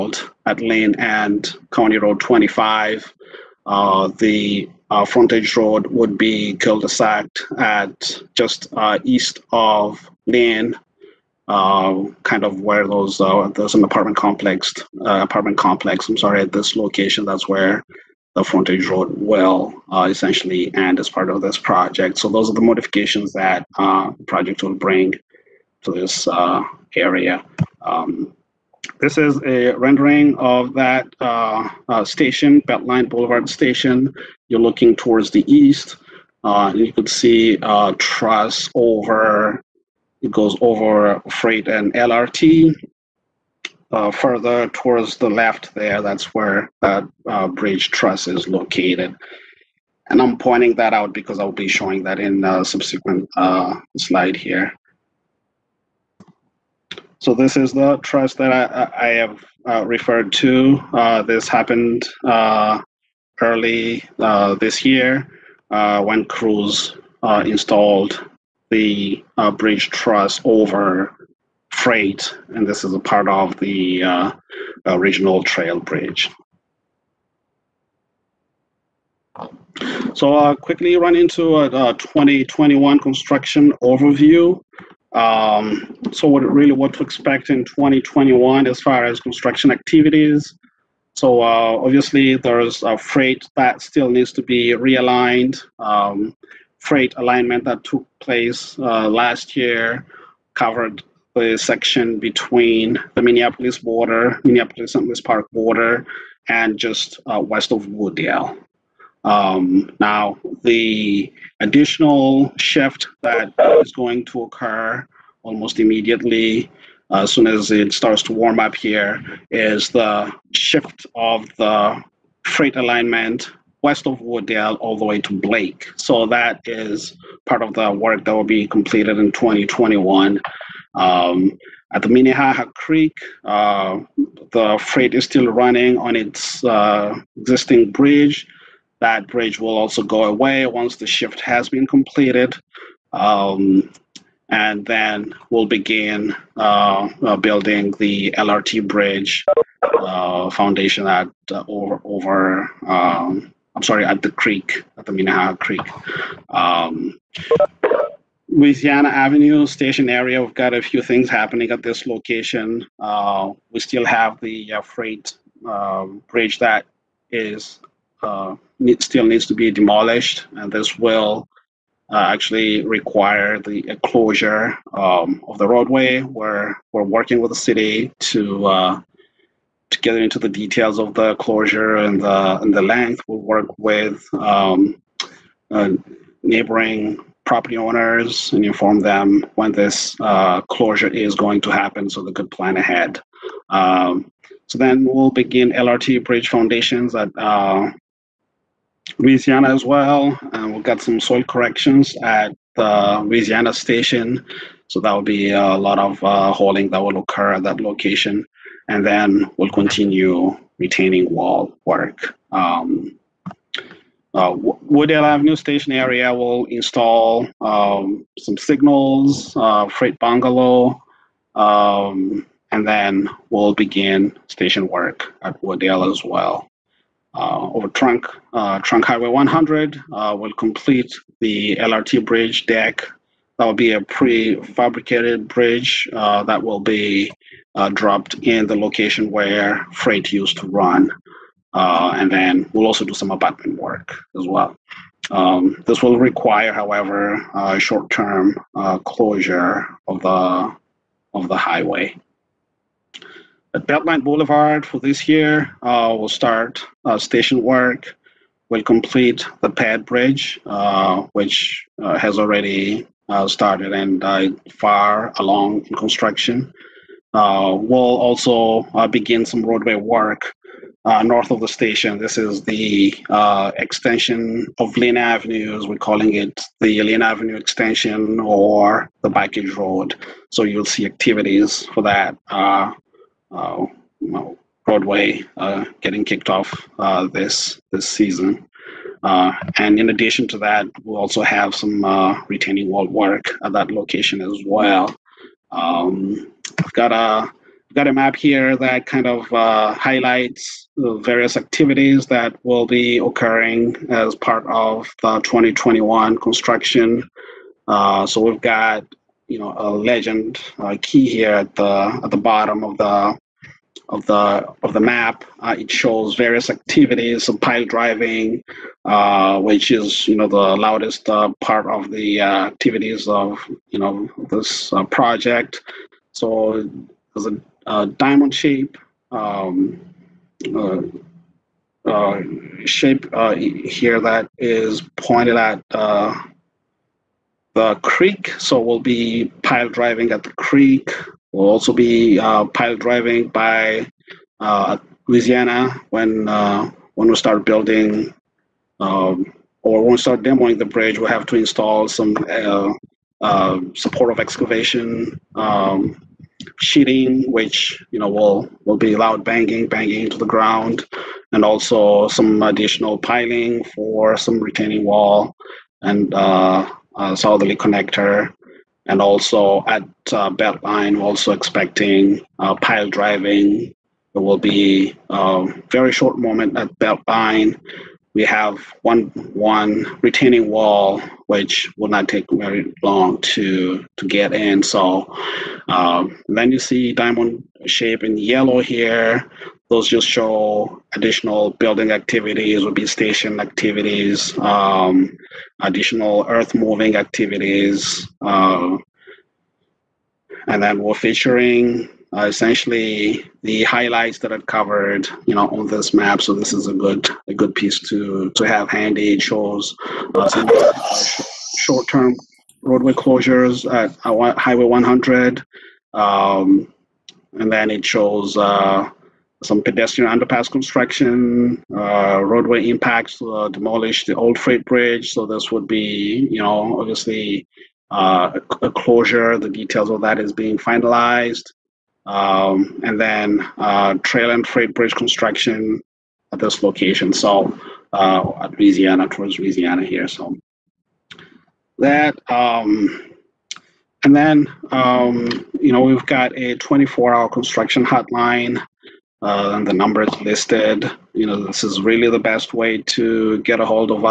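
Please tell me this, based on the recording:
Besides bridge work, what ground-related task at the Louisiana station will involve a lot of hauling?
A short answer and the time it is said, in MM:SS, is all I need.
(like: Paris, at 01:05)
Soil corrections, at 03:21.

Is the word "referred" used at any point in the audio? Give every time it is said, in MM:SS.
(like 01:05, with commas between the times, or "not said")
00:59.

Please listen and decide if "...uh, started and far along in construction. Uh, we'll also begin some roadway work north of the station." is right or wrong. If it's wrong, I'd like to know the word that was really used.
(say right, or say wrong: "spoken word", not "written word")
right.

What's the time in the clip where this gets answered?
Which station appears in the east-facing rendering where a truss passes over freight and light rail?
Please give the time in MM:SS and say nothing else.
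00:32.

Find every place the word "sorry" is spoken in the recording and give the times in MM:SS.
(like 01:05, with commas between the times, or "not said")
00:16, 02:33.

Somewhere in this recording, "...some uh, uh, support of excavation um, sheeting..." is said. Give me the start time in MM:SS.
05:52.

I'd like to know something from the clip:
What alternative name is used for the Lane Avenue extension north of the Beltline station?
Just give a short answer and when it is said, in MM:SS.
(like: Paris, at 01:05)
Backage road, at 04:39.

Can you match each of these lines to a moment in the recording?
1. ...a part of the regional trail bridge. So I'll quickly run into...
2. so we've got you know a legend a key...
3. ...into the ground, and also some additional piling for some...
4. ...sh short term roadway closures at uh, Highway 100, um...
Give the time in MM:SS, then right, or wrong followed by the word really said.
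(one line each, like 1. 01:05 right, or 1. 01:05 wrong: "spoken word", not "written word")
1. 01:12 right
2. 05:07 right
3. 06:00 right
4. 06:51 right.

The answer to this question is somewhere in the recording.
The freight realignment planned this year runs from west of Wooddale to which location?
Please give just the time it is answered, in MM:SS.
02:05.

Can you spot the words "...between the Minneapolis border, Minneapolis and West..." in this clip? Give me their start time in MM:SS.
01:42.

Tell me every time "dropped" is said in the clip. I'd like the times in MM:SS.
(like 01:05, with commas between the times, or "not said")
03:57.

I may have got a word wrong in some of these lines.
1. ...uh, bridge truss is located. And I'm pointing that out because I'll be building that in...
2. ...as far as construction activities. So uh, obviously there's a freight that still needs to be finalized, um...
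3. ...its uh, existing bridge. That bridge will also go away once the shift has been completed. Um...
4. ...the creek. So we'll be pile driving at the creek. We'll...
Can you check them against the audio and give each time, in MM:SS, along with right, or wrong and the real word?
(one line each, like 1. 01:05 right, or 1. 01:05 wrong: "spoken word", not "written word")
1. 00:47 wrong: "showing", not "building"
2. 01:28 wrong: "realigned", not "finalized"
3. 02:16 right
4. 05:37 right.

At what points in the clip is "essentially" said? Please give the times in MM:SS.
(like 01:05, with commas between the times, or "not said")
00:20, 06:42.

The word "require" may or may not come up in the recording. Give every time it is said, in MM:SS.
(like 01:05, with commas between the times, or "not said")
02:52, 04:06.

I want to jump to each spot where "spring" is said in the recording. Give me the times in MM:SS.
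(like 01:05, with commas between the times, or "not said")
not said.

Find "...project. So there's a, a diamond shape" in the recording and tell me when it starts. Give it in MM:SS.
05:25.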